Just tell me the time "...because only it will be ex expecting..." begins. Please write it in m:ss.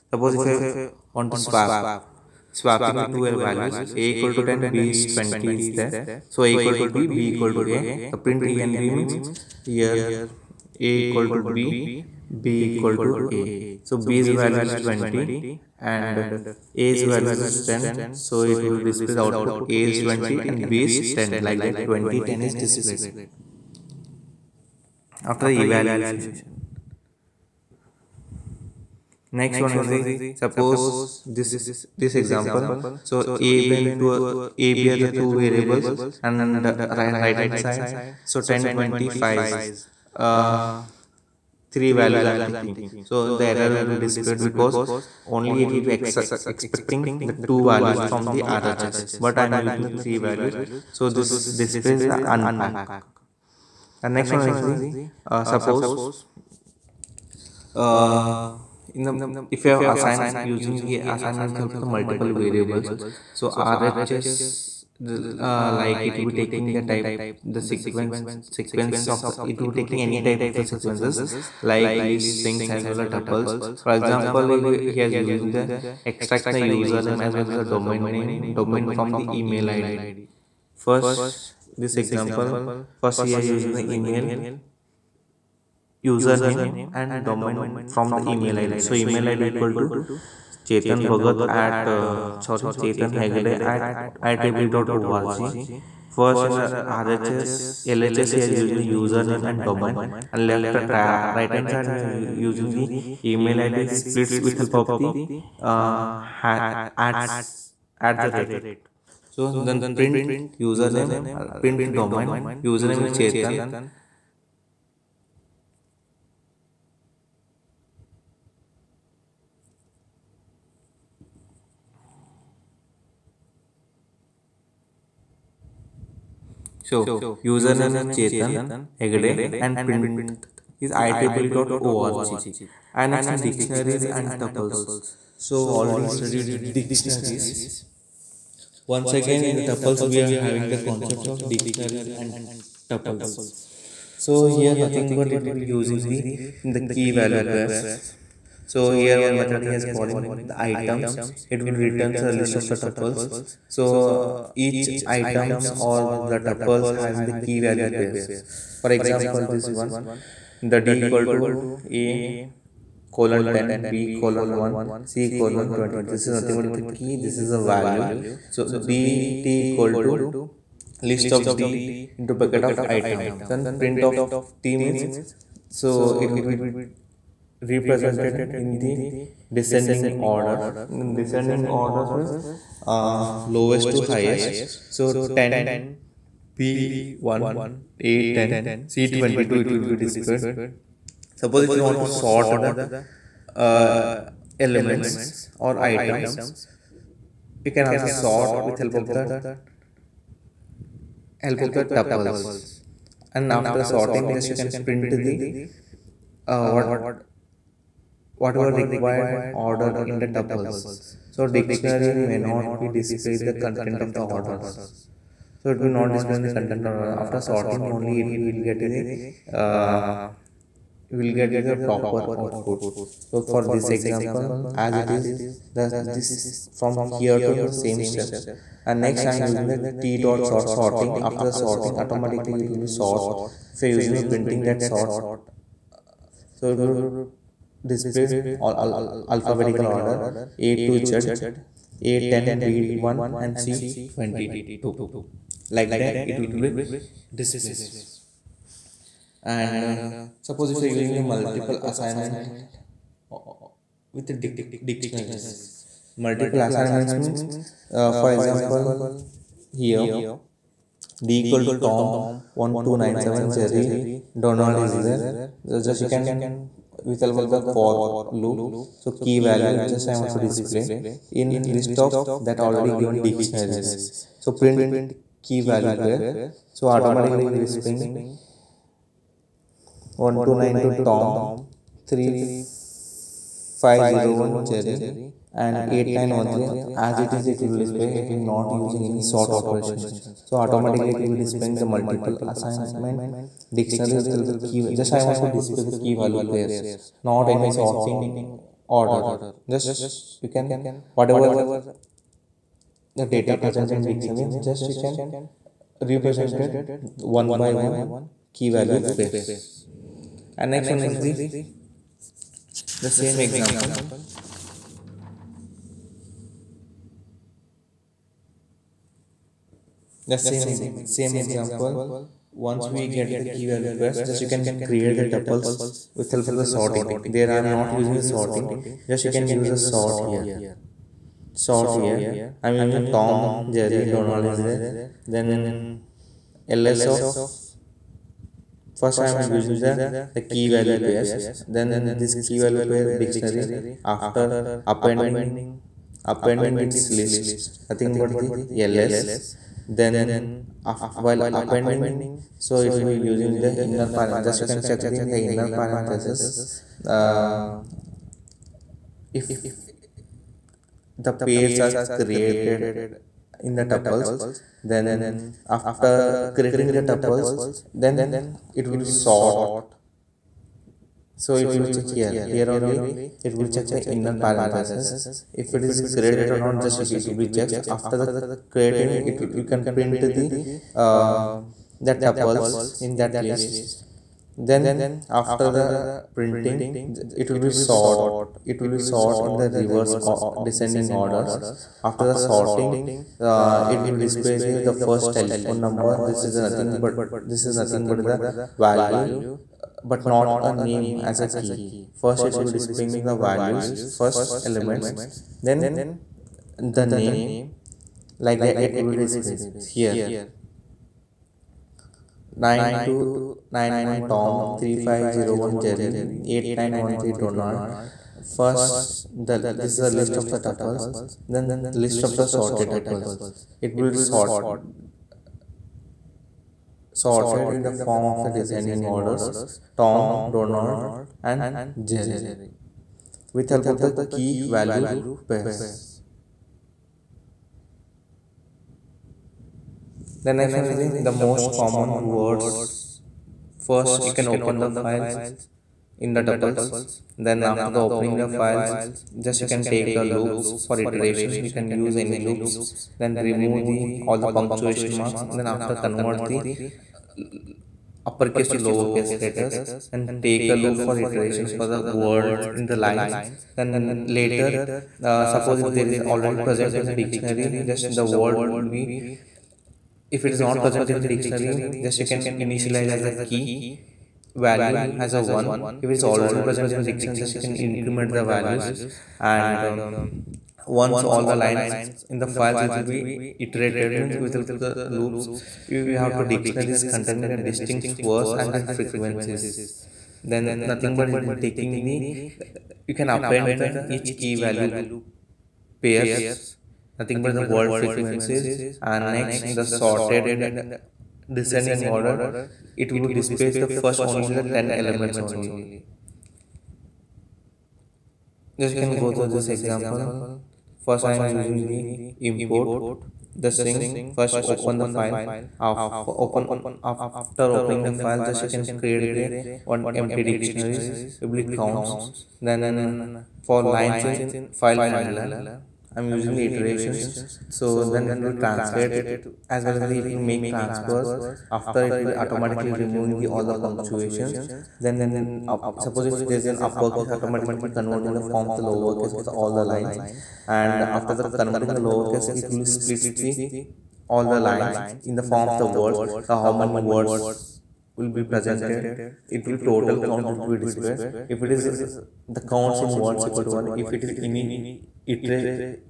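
0:44.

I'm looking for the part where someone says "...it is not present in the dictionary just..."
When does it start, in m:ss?
7:50.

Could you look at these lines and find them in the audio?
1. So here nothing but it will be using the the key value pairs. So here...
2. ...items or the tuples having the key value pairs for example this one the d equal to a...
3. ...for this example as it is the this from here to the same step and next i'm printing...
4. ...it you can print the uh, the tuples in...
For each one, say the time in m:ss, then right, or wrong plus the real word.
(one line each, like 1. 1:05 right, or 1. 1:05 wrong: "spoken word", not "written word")
1. 2:24 right
2. 2:35 right
3. 3:43 wrong: "using", not "printing"
4. 6:19 right.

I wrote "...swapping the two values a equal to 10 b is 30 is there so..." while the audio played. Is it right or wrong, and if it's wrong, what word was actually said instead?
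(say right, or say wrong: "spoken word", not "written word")
wrong: "20", not "30".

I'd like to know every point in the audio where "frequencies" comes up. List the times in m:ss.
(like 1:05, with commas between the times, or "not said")
8:08, 8:18.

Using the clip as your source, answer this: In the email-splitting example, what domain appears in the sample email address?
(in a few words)
iiee.org.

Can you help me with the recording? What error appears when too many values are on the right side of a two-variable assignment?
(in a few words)
unpack.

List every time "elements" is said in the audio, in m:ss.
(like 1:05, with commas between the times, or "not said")
3:14, 6:44, 8:24.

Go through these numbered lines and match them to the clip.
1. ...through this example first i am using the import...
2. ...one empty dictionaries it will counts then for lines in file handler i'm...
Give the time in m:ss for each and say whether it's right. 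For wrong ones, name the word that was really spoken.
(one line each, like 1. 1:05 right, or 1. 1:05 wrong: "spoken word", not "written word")
1. 8:29 right
2. 8:39 right.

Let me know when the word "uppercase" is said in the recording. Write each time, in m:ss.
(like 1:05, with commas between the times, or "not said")
7:38, 8:56.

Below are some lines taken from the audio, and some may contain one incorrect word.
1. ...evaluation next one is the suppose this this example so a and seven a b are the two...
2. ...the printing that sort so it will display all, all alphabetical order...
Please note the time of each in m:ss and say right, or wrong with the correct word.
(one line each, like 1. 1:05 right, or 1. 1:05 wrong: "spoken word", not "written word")
1. 0:25 wrong: "two", not "seven"
2. 3:54 right.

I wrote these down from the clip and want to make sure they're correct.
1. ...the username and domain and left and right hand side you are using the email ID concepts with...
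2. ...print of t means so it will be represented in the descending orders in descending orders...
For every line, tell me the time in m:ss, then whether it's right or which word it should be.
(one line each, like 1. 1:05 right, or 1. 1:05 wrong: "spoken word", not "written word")
1. 1:38 wrong: "splits", not "concepts"
2. 2:53 right.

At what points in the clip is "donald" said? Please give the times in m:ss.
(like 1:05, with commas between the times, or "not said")
4:24, 5:34, 6:57, 7:10.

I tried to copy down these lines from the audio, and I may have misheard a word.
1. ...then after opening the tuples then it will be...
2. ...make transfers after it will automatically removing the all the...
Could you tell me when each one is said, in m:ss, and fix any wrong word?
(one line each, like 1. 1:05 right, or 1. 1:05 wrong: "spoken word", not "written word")
1. 6:04 wrong: "creating", not "opening"
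2. 8:50 right.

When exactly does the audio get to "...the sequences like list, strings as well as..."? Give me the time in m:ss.
1:10.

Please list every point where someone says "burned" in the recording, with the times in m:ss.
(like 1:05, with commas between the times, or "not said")
not said.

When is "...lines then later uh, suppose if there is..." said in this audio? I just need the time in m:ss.
7:43.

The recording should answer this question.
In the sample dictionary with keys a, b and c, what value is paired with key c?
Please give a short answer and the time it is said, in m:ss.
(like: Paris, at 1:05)
20, at 2:45.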